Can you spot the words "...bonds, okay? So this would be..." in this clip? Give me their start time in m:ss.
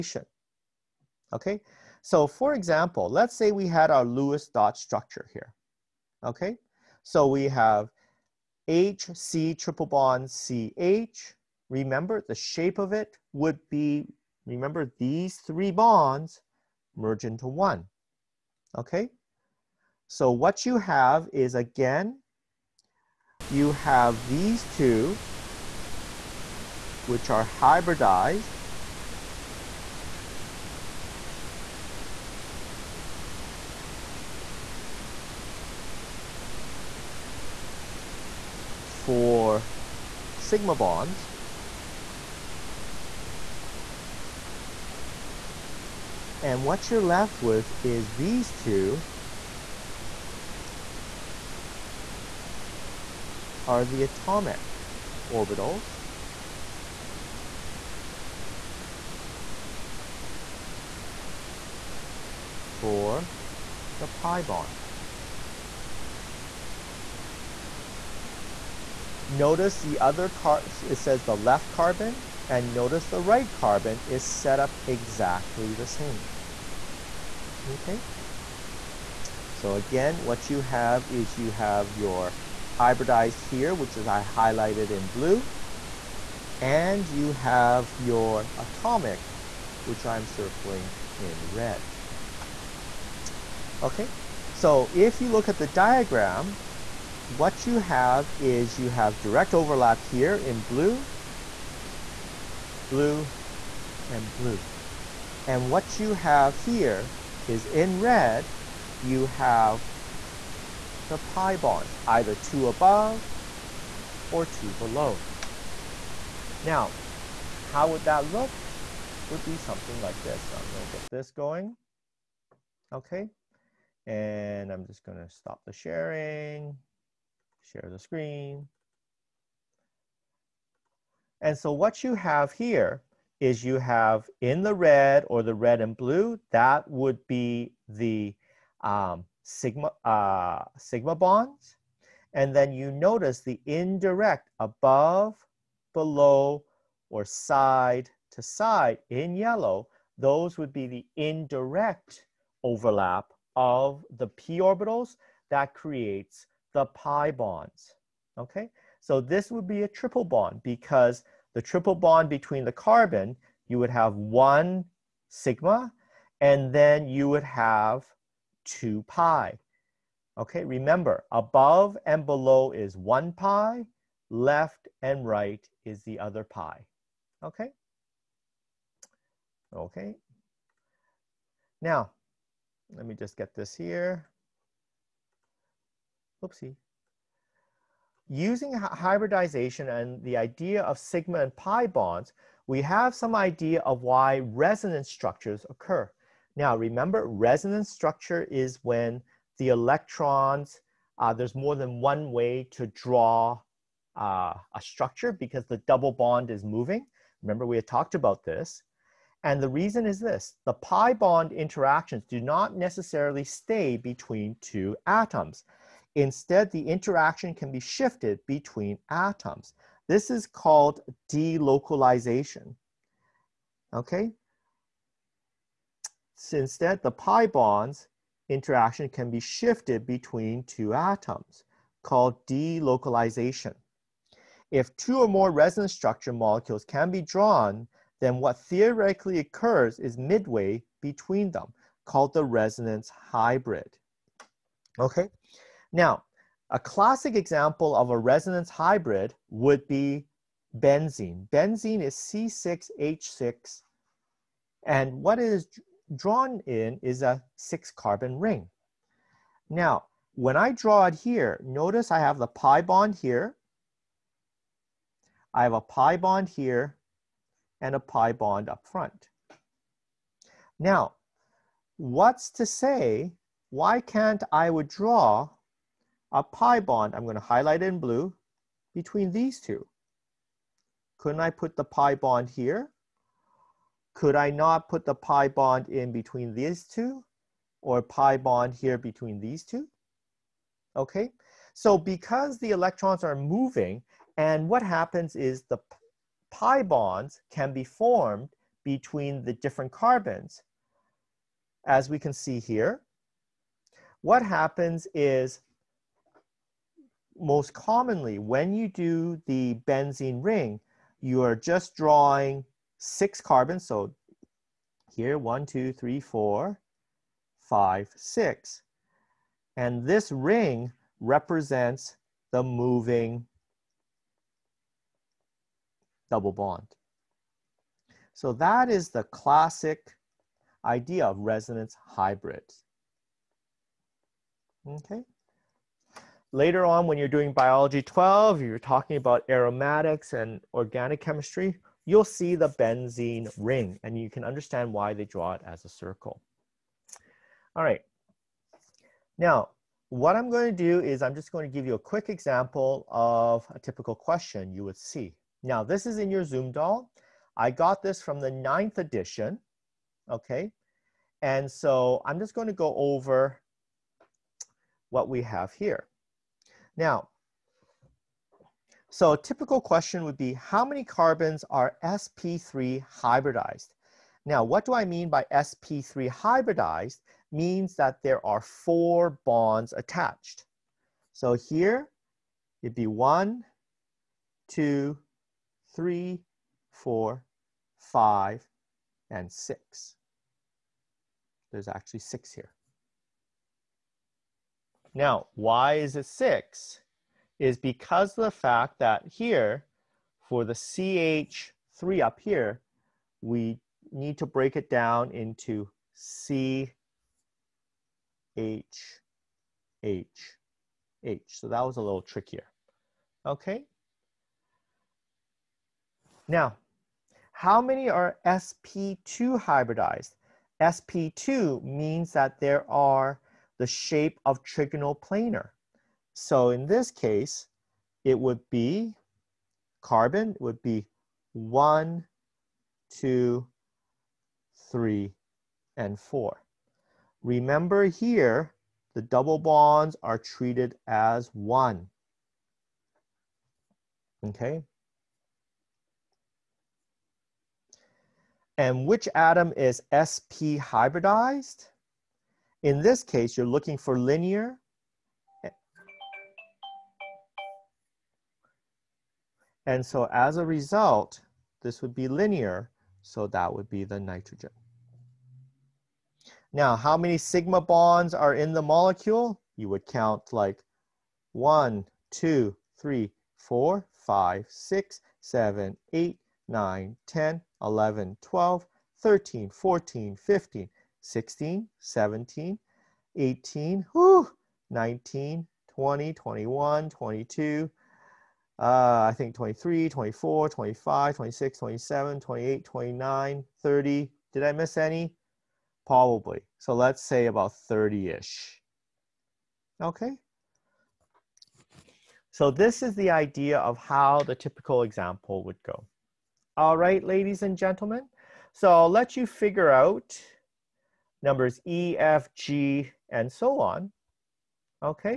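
2:37.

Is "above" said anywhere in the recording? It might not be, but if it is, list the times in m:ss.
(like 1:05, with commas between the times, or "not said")
1:52, 2:24, 2:51.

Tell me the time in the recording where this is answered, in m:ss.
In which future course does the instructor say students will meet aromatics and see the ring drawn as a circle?
5:37.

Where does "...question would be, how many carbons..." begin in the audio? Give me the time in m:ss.
6:09.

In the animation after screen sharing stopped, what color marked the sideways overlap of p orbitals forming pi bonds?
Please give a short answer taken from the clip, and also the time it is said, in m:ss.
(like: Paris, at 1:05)
Yellow, at 2:29.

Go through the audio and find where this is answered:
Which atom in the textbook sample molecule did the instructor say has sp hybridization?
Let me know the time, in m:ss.
7:44.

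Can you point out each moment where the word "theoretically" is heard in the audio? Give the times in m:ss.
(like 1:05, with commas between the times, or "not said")
3:58.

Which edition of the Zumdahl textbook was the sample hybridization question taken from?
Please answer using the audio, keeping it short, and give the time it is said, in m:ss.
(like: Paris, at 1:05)
Ninth edition, at 5:58.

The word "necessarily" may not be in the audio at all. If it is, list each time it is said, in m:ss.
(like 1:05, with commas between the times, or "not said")
3:32.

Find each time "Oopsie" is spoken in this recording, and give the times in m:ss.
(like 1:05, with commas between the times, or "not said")
3:06.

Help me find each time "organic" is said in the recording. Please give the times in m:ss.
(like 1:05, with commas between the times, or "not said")
5:40.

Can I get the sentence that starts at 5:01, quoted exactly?
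As we can see here, what happens is most commonly, when you do the benzene ring, you are just drawing six carbons.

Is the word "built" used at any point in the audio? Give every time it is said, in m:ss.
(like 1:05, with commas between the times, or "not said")
not said.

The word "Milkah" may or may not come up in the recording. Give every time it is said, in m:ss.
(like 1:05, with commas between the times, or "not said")
not said.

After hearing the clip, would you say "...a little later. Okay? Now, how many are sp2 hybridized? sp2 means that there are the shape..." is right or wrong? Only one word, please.
wrong.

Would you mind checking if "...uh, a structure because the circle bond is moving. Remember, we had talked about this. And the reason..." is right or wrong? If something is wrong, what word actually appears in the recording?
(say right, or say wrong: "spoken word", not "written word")
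wrong: "double", not "circle".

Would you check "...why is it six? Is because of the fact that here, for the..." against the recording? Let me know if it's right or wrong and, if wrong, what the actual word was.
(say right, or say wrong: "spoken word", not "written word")
right.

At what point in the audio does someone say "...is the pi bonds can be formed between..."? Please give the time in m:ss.
4:55.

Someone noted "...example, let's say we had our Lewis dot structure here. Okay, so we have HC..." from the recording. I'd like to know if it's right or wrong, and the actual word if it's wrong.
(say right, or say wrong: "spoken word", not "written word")
right.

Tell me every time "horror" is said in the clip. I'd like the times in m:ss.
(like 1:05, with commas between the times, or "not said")
not said.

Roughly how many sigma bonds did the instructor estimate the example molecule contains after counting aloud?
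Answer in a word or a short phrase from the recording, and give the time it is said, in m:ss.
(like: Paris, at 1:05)
About 30, at 8:17.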